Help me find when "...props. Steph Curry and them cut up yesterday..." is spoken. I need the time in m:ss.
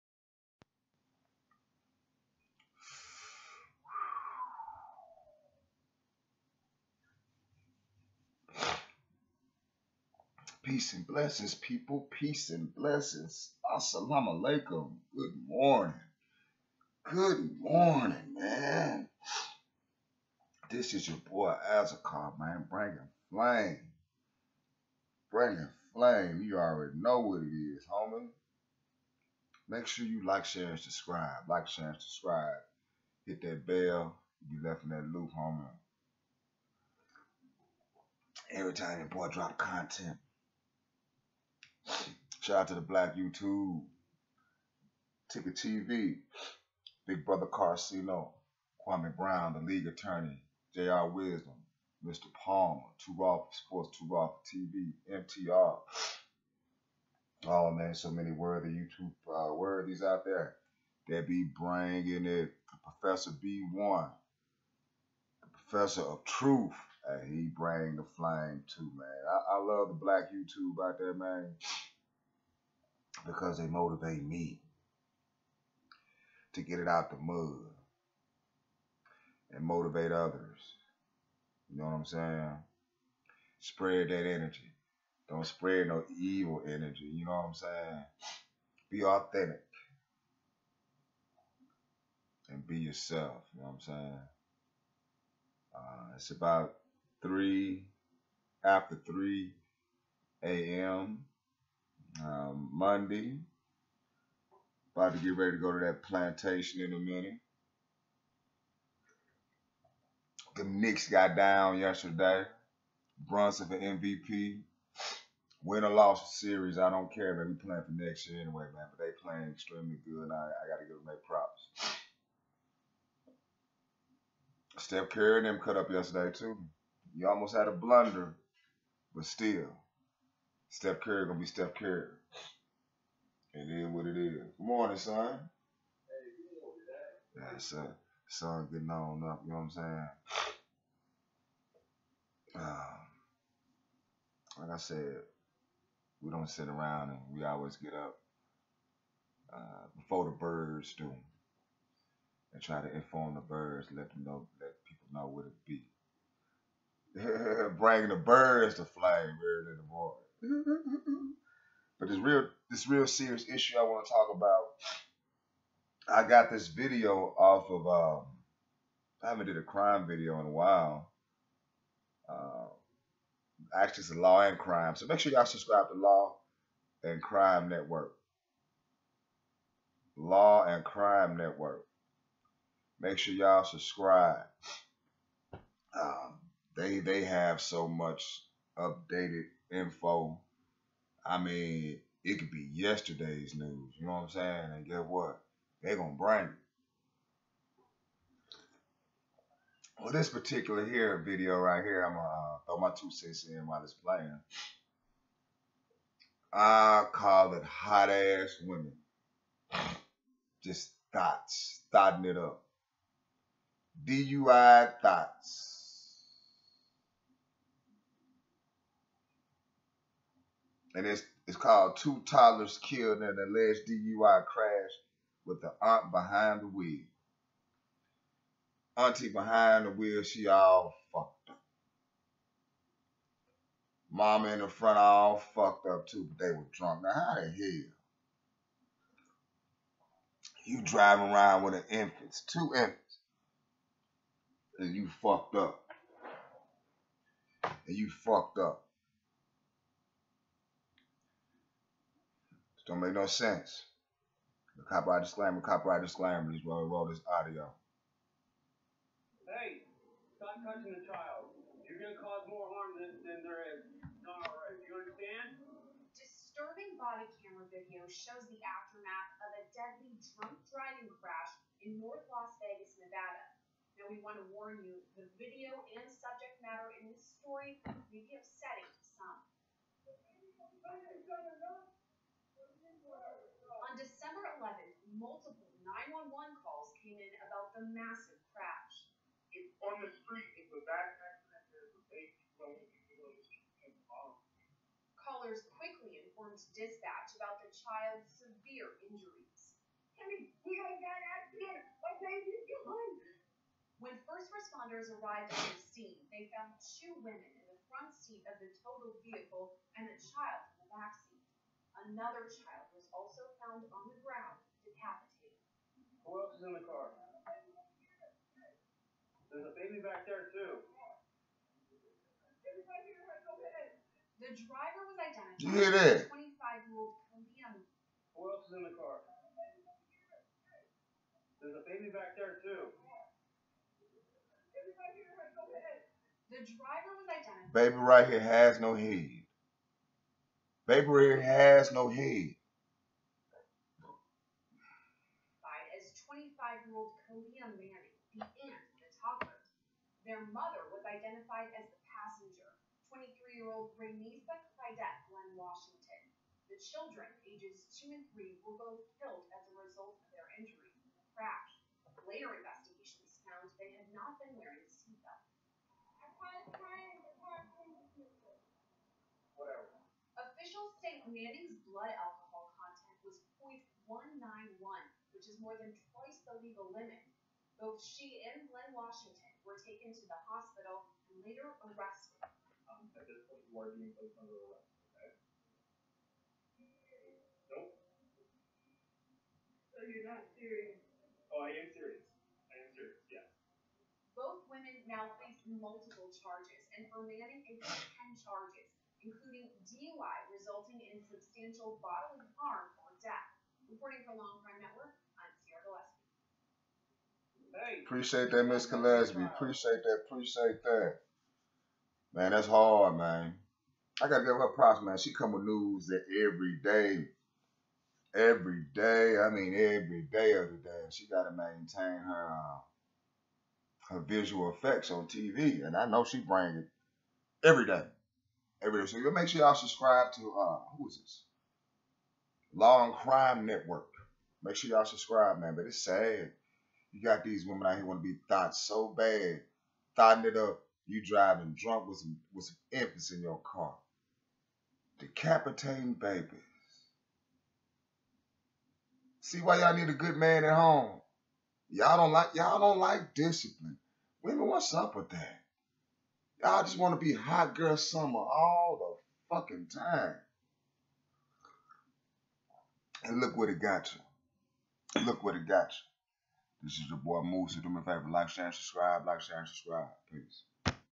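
2:01.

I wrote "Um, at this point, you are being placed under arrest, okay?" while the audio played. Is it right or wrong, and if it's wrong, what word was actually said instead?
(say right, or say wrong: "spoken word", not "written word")
right.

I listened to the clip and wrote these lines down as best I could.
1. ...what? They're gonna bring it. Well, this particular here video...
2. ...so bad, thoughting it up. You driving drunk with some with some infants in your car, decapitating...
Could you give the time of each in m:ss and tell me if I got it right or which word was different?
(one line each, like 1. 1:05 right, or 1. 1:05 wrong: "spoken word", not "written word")
1. 3:15 right
2. 7:18 right.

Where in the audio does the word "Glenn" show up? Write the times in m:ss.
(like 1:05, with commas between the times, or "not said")
5:55, 6:18.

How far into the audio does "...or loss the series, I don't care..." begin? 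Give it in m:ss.
1:55.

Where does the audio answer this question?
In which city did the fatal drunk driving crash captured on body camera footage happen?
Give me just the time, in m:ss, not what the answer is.
4:32.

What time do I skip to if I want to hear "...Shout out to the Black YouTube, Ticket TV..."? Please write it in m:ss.
0:42.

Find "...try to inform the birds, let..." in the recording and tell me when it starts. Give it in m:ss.
2:32.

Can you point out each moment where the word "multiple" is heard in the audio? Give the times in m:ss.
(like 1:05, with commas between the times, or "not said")
4:45, 6:35.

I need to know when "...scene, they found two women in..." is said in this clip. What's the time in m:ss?
5:05.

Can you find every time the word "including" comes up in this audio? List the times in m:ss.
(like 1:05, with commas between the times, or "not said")
6:39.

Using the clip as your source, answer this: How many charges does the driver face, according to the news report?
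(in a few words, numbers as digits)
10.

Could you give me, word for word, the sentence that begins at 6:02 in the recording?
Later investigations found they had not been wearing seatbelts.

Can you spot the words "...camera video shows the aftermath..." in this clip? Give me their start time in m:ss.
4:27.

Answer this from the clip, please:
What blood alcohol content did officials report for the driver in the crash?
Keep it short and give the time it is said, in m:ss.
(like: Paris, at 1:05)
0.191, at 6:14.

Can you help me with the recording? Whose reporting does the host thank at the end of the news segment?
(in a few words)
Miss Gillespie.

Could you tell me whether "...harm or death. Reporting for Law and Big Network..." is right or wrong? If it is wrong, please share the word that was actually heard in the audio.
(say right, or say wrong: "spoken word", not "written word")
wrong: "Crime", not "Big".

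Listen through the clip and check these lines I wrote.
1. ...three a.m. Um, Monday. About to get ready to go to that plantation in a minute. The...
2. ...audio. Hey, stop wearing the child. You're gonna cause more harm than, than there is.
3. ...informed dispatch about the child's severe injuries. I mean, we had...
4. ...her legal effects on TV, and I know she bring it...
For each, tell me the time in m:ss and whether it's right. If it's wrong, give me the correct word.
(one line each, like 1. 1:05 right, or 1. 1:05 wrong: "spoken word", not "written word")
1. 1:39 right
2. 4:17 wrong: "touching", not "wearing"
3. 4:56 right
4. 7:04 wrong: "visual", not "legal".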